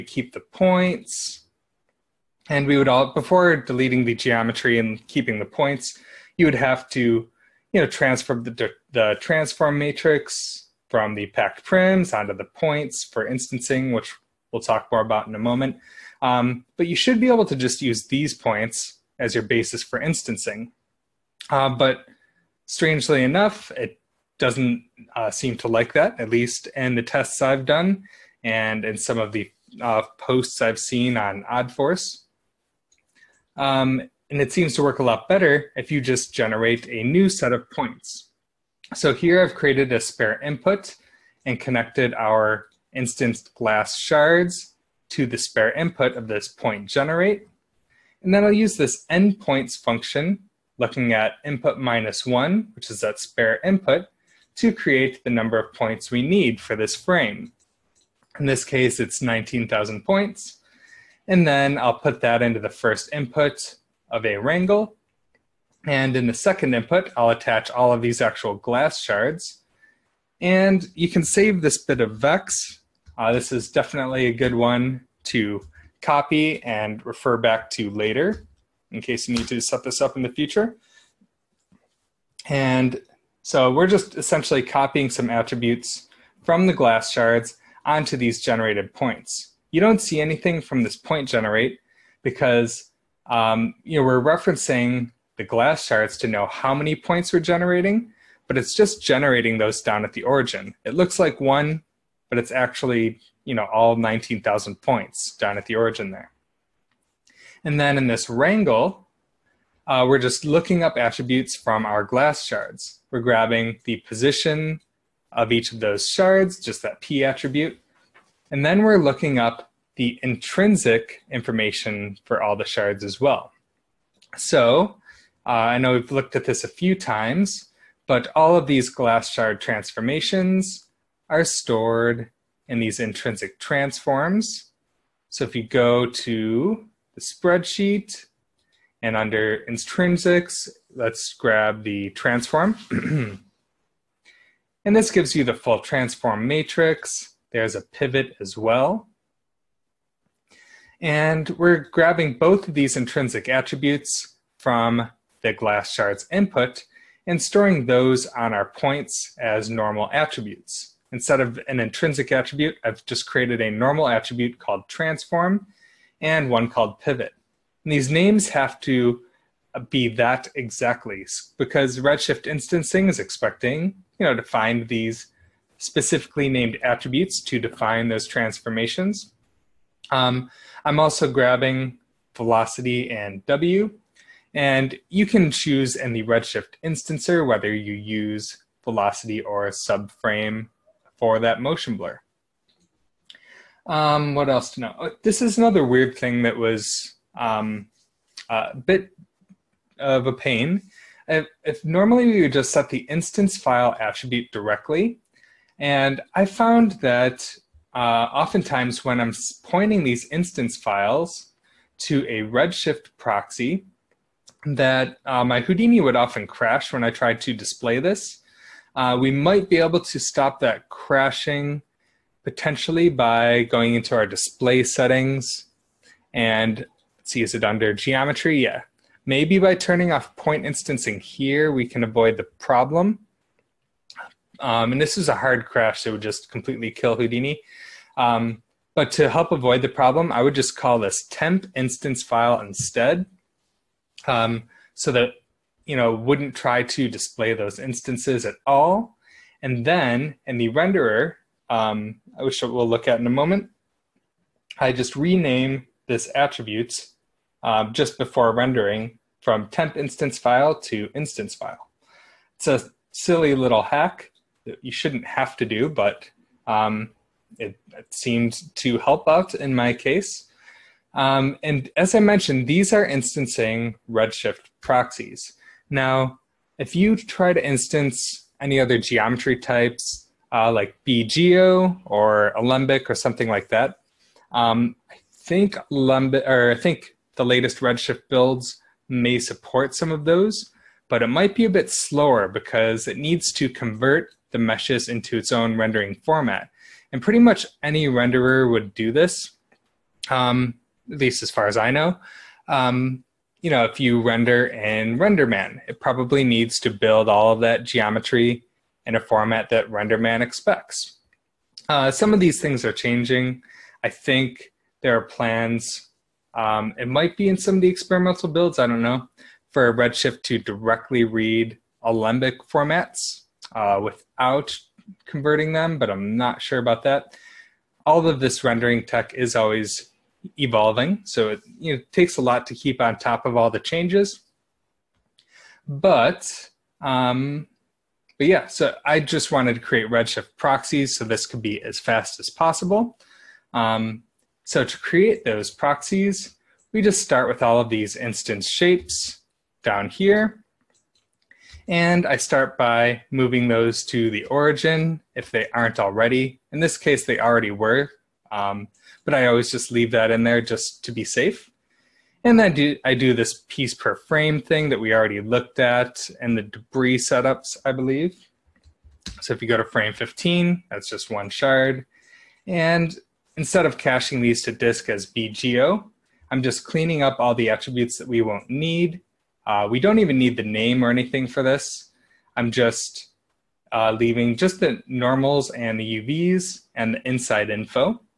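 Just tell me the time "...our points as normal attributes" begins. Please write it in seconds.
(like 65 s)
158 s.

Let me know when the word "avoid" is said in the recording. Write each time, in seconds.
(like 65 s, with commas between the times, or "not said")
232 s, 239 s.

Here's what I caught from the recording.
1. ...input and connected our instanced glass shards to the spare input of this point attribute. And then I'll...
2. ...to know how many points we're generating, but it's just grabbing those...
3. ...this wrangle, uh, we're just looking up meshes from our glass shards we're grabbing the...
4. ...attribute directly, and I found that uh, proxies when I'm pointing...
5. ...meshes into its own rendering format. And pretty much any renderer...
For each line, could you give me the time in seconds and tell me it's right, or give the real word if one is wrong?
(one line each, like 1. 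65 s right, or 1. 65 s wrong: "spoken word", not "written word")
1. 40 s wrong: "generate", not "attribute"
2. 96 s wrong: "generating", not "grabbing"
3. 108 s wrong: "attributes", not "meshes"
4. 203 s wrong: "oftentimes", not "proxies"
5. 294 s right.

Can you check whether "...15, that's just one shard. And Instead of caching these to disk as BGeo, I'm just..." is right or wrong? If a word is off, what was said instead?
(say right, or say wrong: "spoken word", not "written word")
right.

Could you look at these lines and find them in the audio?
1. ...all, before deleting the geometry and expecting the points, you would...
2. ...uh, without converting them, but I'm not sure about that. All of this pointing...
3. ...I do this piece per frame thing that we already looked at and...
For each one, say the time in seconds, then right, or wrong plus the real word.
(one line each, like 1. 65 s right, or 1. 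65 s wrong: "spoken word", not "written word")
1. 2 s wrong: "keeping", not "expecting"
2. 323 s wrong: "rendering", not "pointing"
3. 363 s right.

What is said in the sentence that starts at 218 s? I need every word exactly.
Uh, we might be able to stop that crashing potentially by going into our display settings and see, is it under geometry?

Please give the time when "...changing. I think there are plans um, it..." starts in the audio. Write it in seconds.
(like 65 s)
312 s.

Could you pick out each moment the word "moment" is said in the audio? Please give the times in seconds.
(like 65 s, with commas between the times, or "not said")
15 s, 253 s.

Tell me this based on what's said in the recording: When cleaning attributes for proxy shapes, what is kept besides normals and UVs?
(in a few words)
inside info.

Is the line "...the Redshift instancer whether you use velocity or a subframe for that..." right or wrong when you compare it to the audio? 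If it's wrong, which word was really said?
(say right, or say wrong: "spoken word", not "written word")
right.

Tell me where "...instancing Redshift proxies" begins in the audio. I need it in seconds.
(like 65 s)
273 s.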